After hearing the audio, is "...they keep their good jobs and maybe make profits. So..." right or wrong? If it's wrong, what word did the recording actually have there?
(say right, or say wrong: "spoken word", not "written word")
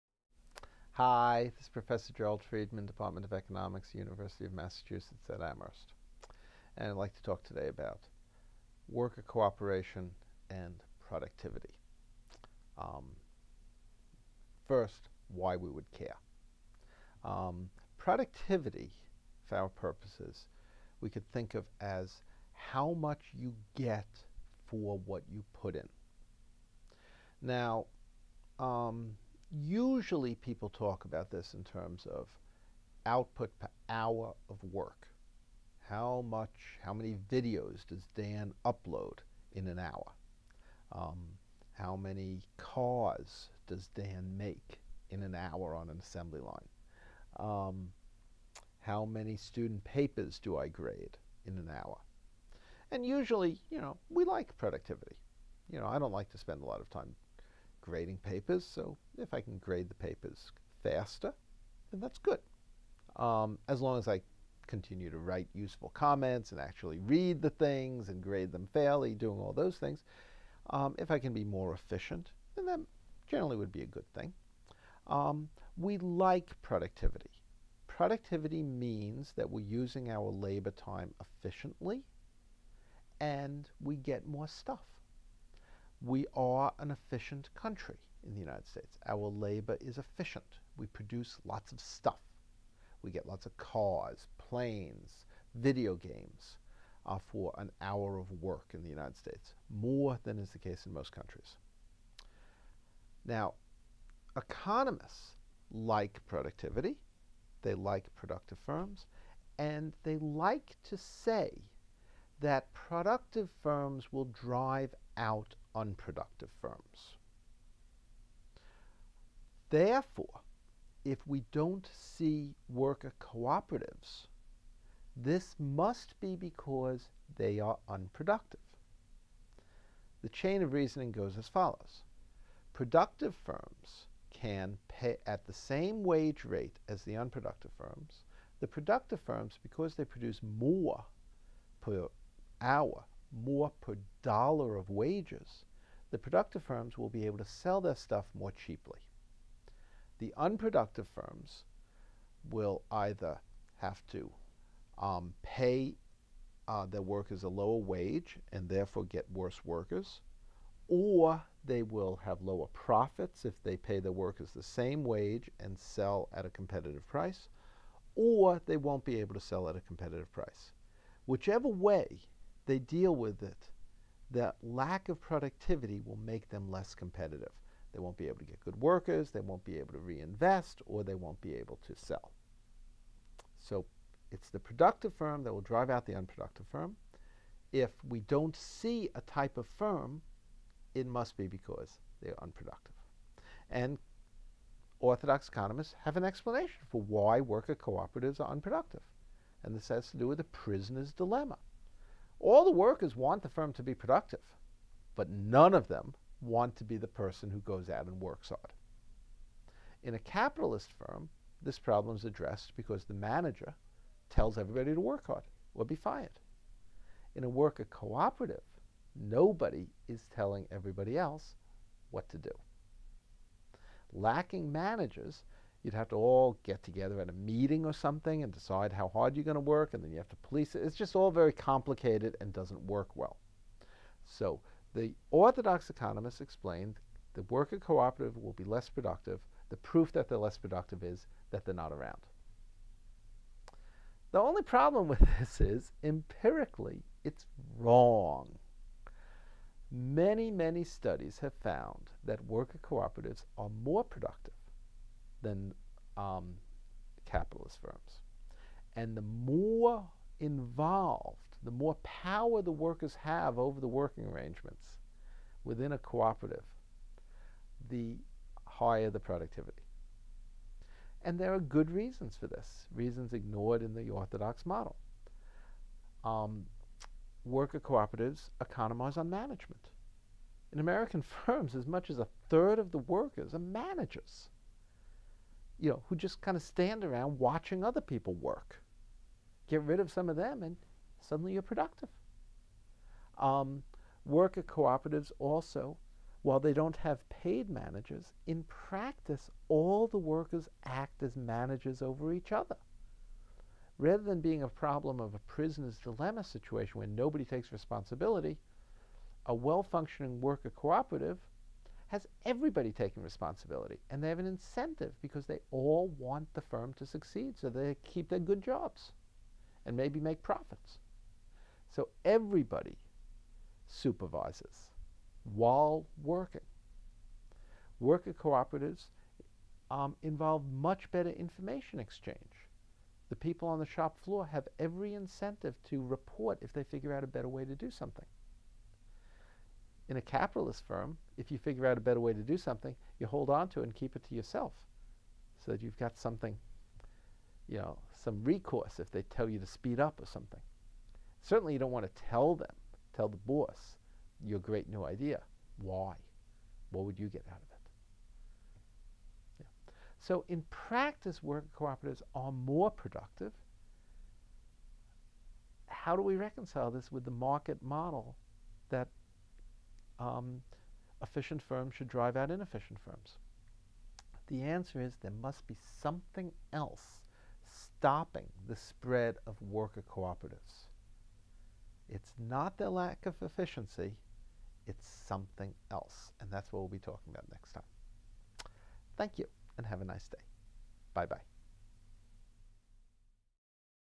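right.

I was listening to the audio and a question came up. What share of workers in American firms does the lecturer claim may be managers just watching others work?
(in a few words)
a third.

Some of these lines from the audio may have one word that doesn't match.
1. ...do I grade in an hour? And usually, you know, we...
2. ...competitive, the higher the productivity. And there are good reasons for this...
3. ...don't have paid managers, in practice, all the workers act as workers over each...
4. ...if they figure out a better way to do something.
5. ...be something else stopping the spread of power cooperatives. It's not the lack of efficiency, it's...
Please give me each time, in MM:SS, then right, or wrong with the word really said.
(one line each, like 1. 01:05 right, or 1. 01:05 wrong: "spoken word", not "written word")
1. 00:50 right
2. 04:25 wrong: "cooperative", not "competitive"
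3. 04:56 wrong: "managers", not "workers"
4. 05:36 right
5. 06:15 wrong: "worker", not "power".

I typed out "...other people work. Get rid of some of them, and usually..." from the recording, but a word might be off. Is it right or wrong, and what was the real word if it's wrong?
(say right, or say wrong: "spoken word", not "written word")
wrong: "suddenly", not "usually".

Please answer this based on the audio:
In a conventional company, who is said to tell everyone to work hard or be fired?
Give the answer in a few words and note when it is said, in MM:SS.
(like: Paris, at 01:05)
the manager, at 03:33.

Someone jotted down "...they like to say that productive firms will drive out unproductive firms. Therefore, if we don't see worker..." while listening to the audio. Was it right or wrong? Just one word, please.
right.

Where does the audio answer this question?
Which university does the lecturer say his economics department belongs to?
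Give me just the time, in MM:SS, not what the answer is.
00:03.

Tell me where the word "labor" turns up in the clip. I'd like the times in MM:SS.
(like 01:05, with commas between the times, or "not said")
01:20, 01:29.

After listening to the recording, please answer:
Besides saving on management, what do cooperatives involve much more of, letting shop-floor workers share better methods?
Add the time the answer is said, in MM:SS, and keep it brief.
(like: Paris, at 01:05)
information exchange, at 05:31.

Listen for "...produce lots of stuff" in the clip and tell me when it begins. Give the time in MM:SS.
01:30.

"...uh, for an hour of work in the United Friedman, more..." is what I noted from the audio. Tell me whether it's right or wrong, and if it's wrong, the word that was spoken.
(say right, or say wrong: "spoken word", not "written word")
wrong: "States", not "Friedman".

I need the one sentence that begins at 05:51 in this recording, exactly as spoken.
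Certainly, you don't want to tell them, tell the boss, your great new idea.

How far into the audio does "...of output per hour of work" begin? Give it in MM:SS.
00:32.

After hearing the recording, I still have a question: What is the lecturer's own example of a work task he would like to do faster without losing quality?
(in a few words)
grading papers.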